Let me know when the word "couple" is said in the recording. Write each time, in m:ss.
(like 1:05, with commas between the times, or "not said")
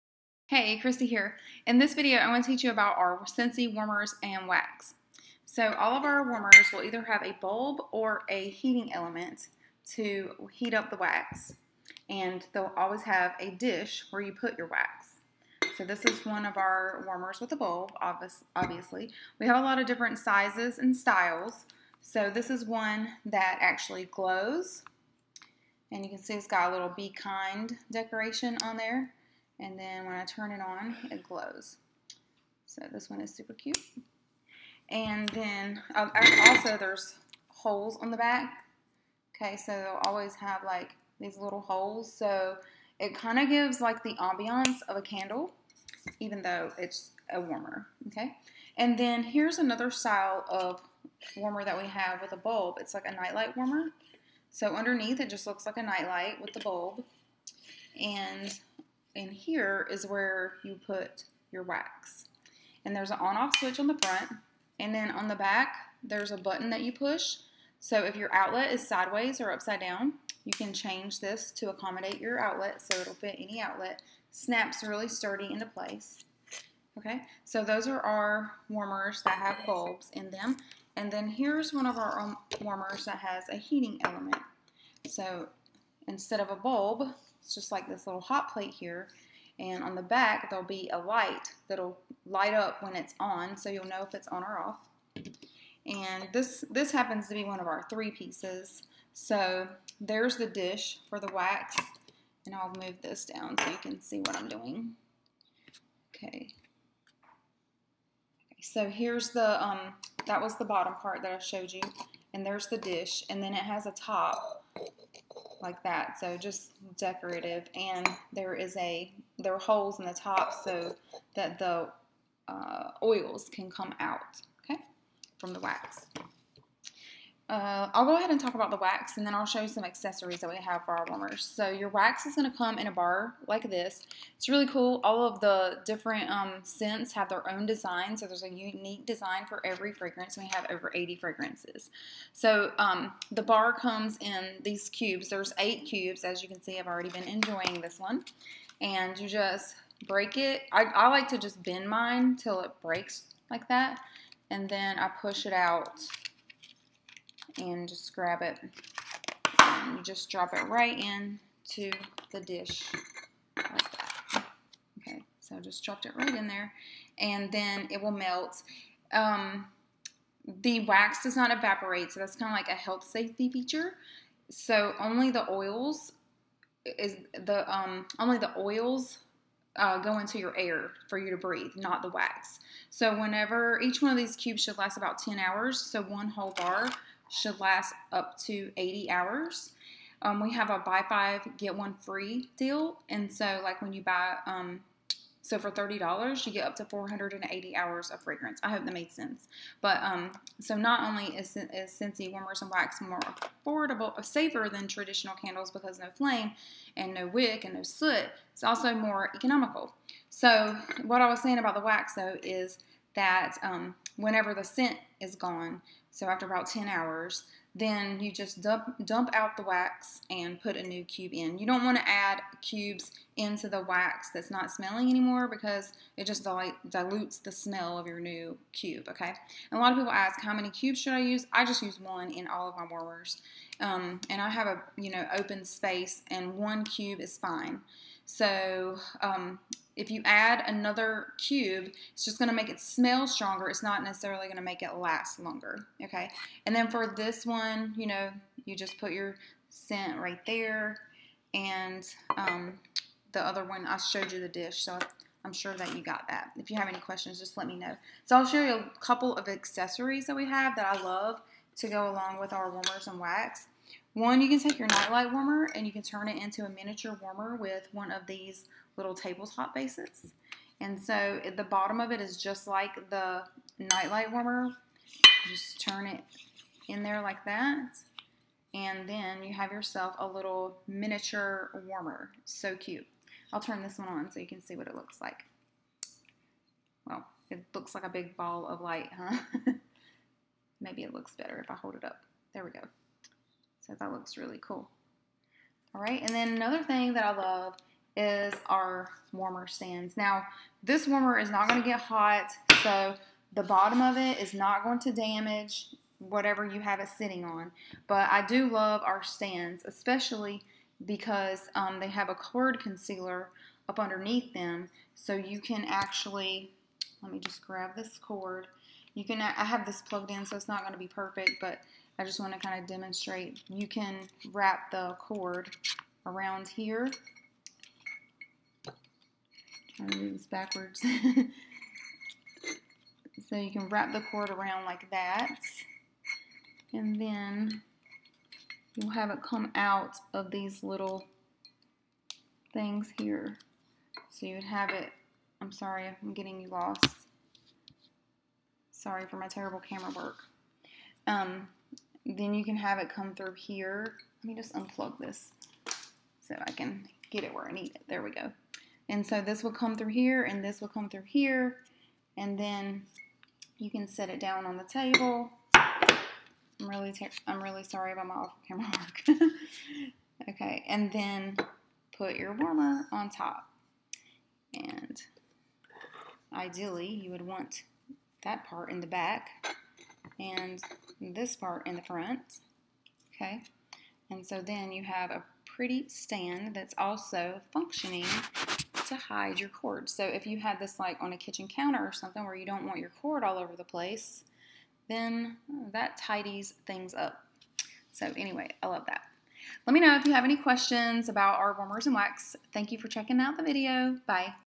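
4:19.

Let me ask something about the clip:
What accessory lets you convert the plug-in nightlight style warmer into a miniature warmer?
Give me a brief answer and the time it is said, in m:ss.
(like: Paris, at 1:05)
tabletop bases, at 4:29.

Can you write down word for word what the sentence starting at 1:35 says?
And this, this happens to be one of our three pieces.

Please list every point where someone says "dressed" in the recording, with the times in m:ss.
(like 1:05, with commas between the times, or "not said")
not said.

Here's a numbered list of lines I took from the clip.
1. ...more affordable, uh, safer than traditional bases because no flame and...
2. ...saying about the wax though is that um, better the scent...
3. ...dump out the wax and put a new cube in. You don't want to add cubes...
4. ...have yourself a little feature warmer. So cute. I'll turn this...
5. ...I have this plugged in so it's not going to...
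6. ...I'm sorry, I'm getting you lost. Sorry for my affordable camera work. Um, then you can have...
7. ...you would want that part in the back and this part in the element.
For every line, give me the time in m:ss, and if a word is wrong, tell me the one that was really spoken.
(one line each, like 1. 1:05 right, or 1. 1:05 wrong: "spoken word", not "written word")
1. 3:23 wrong: "candles", not "bases"
2. 3:31 wrong: "whenever", not "better"
3. 3:39 right
4. 4:39 wrong: "miniature", not "feature"
5. 5:19 right
6. 5:45 wrong: "terrible", not "affordable"
7. 6:17 wrong: "front", not "element".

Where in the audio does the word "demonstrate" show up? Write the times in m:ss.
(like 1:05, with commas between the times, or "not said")
5:22.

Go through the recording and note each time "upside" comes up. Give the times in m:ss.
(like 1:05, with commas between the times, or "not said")
1:09.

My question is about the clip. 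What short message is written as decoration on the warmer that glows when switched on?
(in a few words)
be kind.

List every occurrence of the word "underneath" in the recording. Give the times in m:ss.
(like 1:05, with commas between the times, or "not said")
0:54, 5:13.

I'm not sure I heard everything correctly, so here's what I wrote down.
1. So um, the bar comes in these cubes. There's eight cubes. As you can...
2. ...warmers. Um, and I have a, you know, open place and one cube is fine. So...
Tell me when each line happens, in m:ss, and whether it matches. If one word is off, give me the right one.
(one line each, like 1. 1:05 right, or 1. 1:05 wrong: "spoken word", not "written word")
1. 2:22 right
2. 3:52 wrong: "space", not "place".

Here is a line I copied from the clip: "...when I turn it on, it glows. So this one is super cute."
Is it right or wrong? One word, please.
right.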